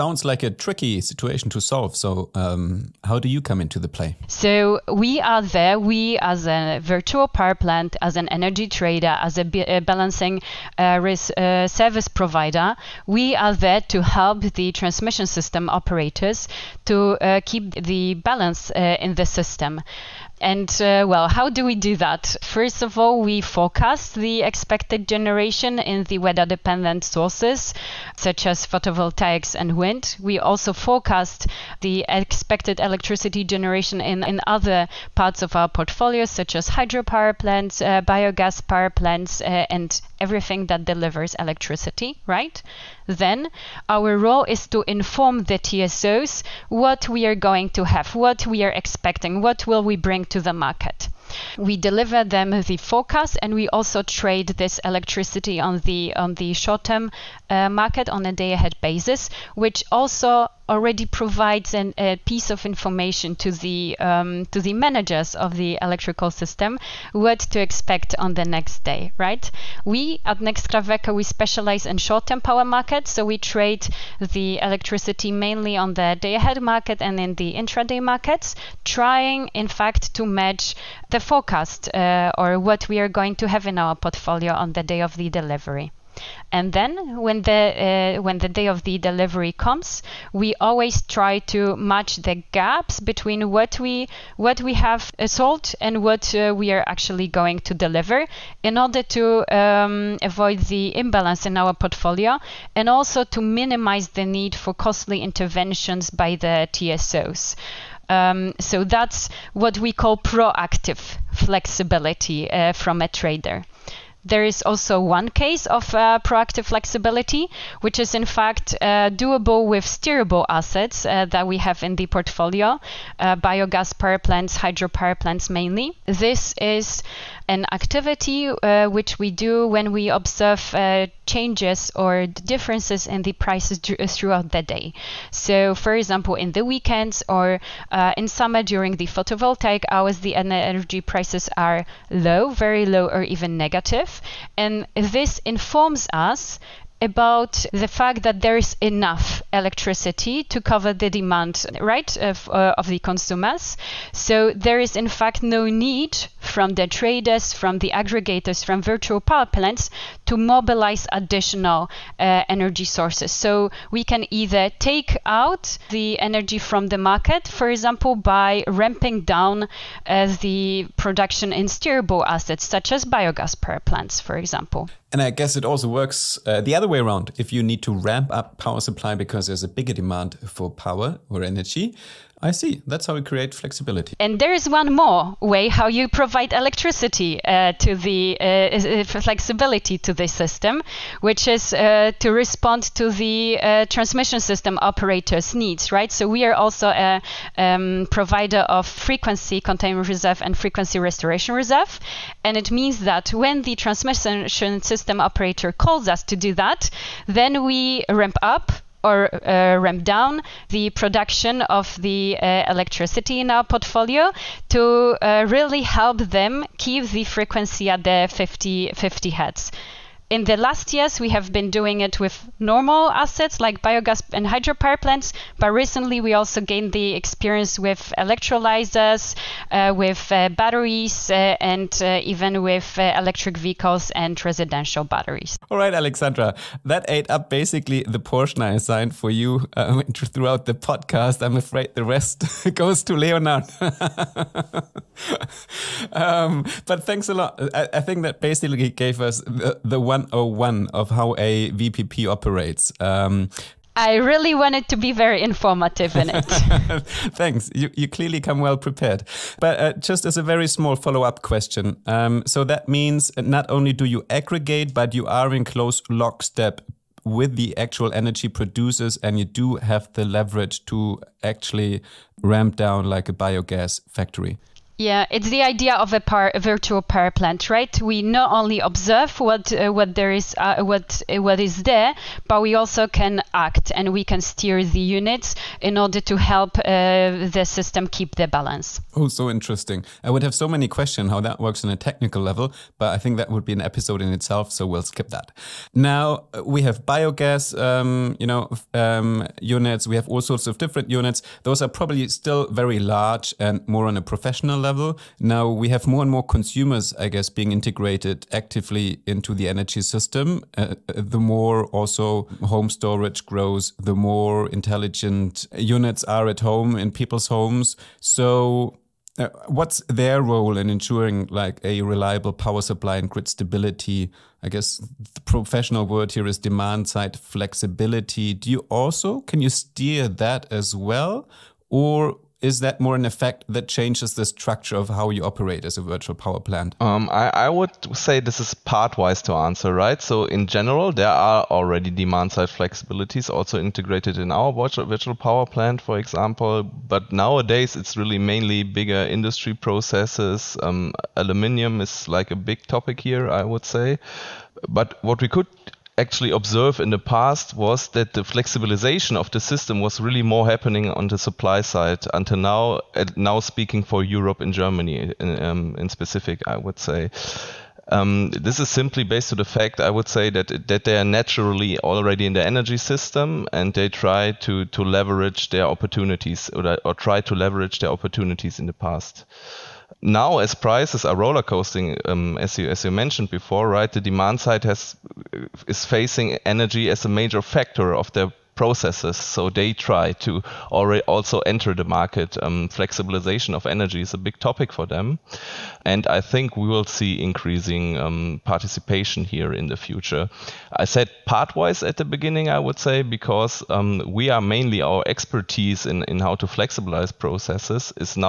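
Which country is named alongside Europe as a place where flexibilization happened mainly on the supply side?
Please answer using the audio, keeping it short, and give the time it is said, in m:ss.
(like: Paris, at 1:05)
Germany, at 6:04.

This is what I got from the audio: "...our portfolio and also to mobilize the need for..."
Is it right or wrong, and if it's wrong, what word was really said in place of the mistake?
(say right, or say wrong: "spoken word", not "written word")
wrong: "minimize", not "mobilize".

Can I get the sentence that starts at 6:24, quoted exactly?
The demand side has is facing energy as a major factor of their processes.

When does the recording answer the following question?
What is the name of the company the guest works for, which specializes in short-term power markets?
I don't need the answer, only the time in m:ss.
1:10.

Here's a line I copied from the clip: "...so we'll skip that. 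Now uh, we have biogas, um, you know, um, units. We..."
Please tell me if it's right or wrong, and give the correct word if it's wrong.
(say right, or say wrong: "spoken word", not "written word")
right.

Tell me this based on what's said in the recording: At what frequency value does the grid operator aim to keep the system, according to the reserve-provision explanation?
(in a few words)
50 hertz.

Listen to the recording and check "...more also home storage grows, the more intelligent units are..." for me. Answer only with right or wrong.
right.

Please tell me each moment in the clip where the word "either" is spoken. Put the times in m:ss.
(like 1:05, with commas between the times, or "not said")
2:44.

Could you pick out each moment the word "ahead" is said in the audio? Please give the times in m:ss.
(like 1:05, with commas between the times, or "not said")
0:58, 1:16.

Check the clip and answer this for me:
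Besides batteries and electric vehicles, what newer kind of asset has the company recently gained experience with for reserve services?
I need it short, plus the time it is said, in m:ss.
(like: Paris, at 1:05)
Electrolyzers, at 3:48.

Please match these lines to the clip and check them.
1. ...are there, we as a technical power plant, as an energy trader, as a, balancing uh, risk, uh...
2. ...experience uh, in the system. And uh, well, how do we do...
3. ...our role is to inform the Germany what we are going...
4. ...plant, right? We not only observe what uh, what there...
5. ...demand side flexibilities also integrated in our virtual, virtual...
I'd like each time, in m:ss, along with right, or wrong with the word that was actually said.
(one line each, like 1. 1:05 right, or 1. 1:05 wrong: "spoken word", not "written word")
1. 0:05 wrong: "virtual", not "technical"
2. 0:18 wrong: "balance", not "experience"
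3. 0:43 wrong: "TSOs", not "Germany"
4. 4:37 right
5. 5:42 right.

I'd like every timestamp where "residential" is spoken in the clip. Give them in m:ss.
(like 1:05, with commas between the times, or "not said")
3:54.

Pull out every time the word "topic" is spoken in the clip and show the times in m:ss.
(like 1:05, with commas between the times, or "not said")
5:52, 6:34.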